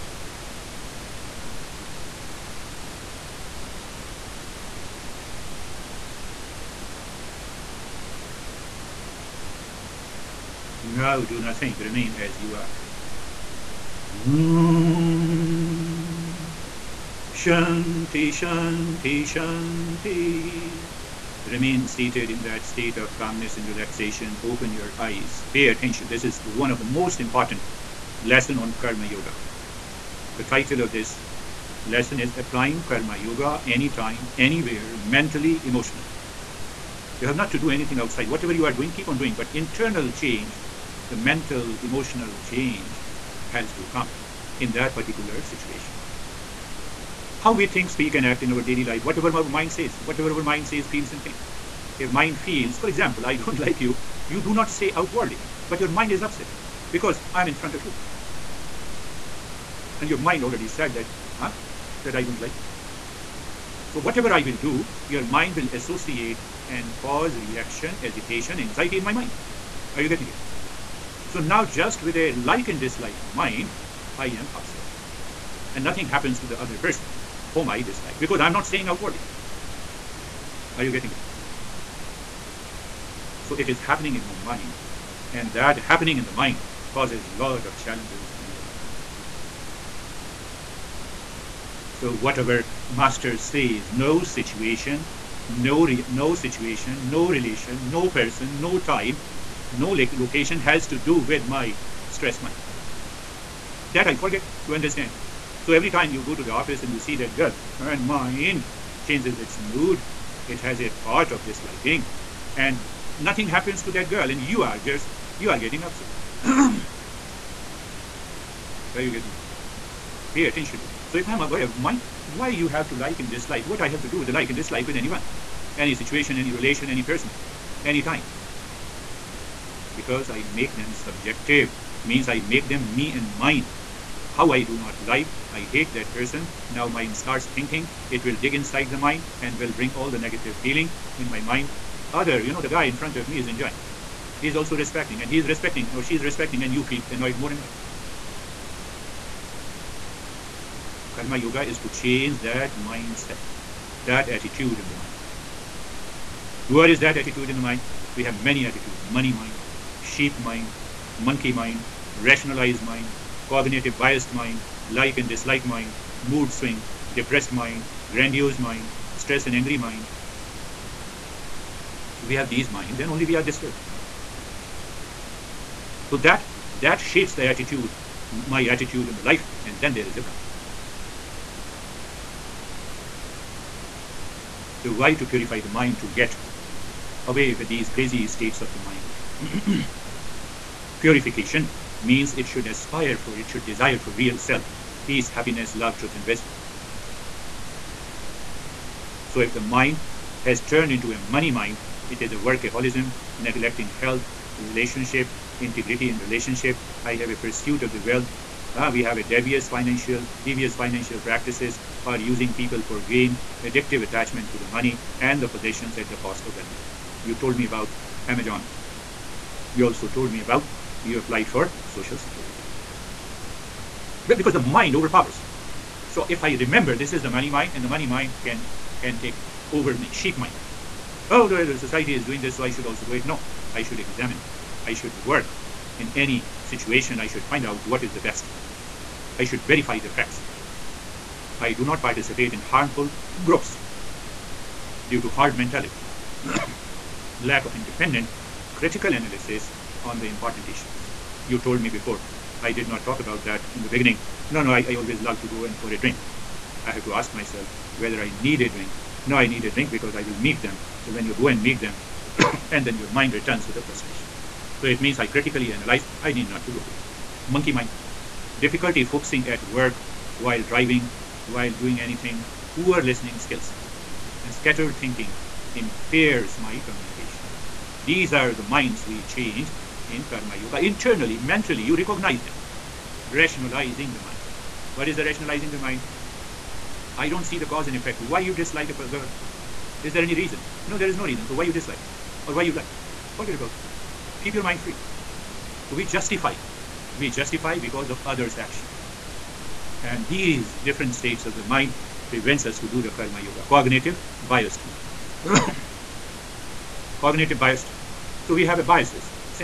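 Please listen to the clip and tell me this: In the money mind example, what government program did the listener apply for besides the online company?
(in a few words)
Social security.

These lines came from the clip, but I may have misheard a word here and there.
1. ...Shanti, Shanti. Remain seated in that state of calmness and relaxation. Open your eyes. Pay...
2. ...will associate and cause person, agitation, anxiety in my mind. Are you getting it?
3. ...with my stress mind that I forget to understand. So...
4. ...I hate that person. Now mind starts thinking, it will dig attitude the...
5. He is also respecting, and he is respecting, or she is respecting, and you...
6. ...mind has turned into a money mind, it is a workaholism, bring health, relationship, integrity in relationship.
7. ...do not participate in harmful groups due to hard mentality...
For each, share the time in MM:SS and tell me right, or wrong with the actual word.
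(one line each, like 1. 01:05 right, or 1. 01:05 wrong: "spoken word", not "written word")
1. 00:18 right
2. 01:05 wrong: "reaction", not "person"
3. 01:41 right
4. 02:15 wrong: "inside", not "attitude"
5. 02:24 right
6. 03:19 wrong: "neglecting", not "bring"
7. 04:01 right.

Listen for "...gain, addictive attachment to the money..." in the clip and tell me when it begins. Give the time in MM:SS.
03:33.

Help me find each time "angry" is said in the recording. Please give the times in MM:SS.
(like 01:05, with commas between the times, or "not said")
02:49.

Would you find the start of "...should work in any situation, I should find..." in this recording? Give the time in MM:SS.
03:54.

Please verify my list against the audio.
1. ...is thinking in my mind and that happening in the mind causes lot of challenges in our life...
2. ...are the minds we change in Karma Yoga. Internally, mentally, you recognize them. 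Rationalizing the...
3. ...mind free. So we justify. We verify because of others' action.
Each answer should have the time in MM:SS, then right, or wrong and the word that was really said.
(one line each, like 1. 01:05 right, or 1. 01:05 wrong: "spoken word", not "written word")
1. 01:23 wrong: "happening", not "thinking"
2. 04:38 right
3. 04:54 wrong: "justify", not "verify".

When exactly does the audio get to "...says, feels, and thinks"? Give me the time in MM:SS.
00:50.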